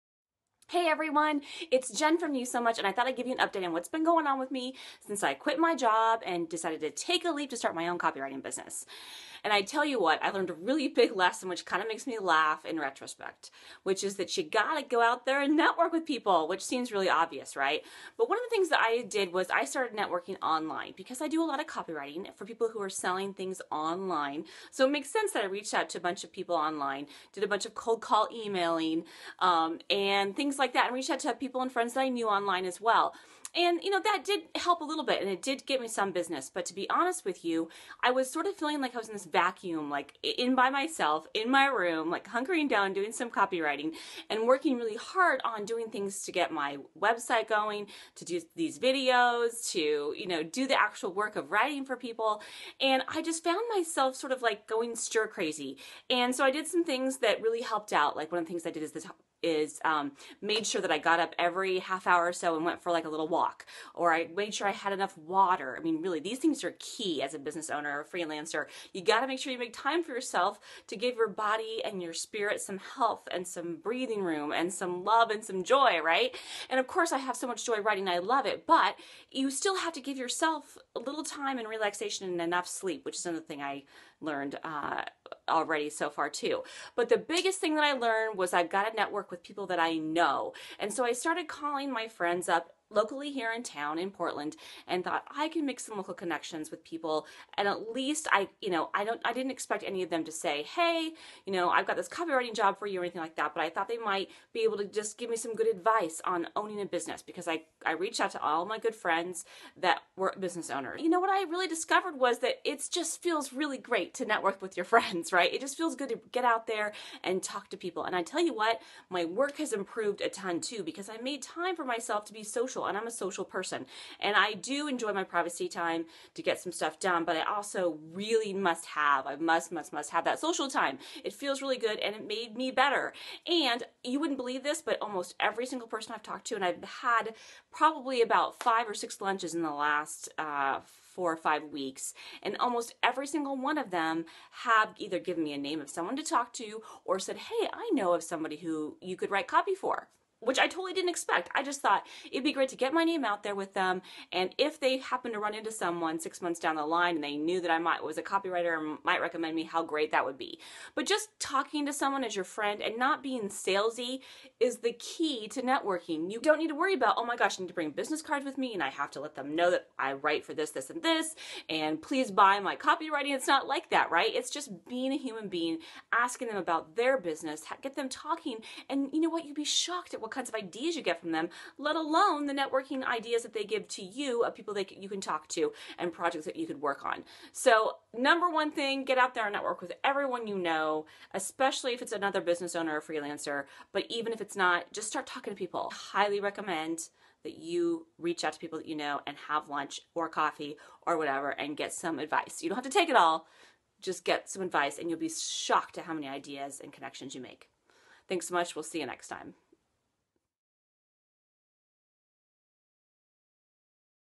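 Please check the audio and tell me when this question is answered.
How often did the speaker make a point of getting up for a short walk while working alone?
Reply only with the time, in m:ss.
1:01.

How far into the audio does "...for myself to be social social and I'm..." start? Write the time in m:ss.
2:01.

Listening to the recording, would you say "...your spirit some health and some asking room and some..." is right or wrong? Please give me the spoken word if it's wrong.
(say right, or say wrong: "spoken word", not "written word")
wrong: "breathing", not "asking".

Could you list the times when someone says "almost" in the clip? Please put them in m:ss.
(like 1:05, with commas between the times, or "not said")
2:15, 2:22.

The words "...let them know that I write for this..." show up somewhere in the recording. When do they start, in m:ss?
2:49.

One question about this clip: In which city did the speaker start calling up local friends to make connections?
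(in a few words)
Portland.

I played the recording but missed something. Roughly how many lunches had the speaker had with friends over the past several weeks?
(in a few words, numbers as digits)
5 or 6.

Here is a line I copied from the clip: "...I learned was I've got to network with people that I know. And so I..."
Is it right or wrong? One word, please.
right.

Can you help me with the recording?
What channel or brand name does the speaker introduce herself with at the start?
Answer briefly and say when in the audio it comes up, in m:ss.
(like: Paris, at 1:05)
You So Much, at 0:02.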